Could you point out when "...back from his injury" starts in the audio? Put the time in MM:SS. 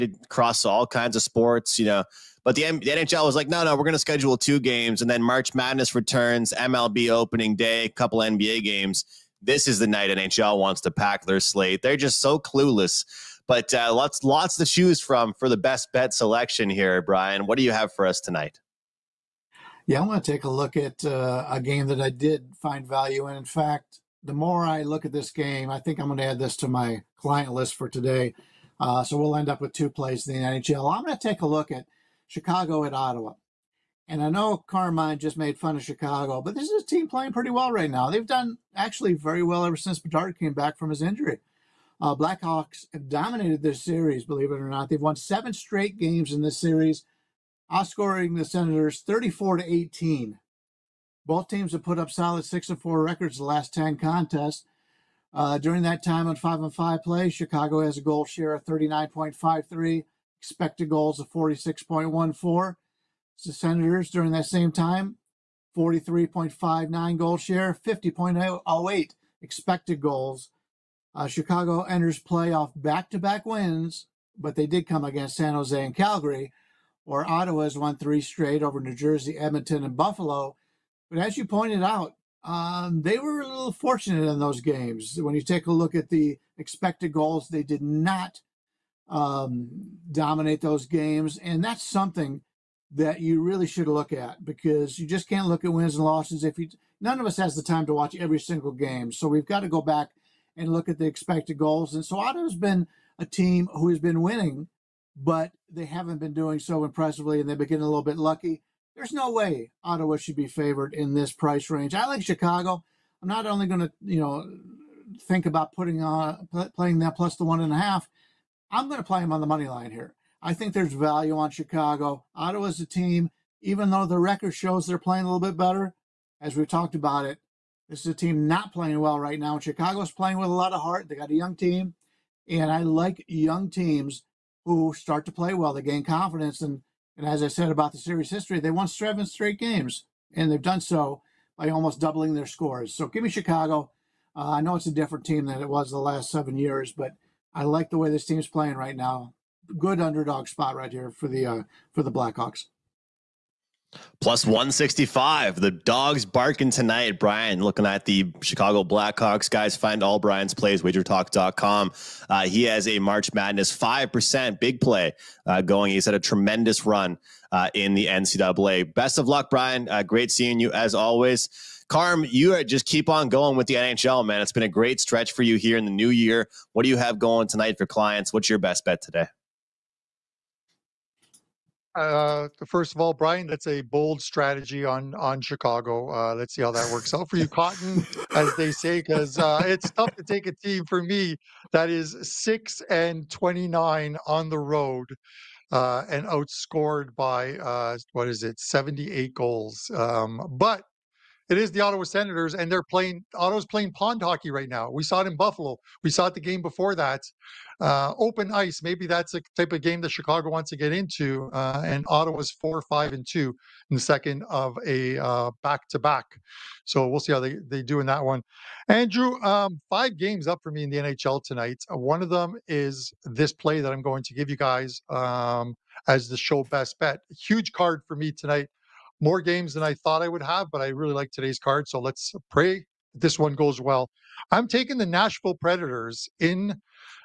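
00:40.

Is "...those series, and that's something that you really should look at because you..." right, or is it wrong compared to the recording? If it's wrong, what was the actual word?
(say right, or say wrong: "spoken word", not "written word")
wrong: "games", not "series".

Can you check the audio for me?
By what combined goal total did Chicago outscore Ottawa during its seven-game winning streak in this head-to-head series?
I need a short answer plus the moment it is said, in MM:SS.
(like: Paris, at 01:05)
34 to 18, at 00:48.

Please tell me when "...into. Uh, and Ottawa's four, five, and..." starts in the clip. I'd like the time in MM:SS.
03:30.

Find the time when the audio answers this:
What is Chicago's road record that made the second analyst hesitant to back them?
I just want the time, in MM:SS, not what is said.
03:12.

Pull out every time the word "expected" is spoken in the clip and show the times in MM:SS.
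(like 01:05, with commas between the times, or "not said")
01:00, 01:09, 01:26, 01:41.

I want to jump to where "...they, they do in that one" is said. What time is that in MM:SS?
03:37.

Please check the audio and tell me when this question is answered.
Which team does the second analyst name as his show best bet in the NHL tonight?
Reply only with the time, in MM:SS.
03:55.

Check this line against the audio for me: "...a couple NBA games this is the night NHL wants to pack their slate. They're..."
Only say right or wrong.
right.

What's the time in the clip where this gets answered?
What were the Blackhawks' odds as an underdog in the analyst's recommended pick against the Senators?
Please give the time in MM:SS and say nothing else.
02:34.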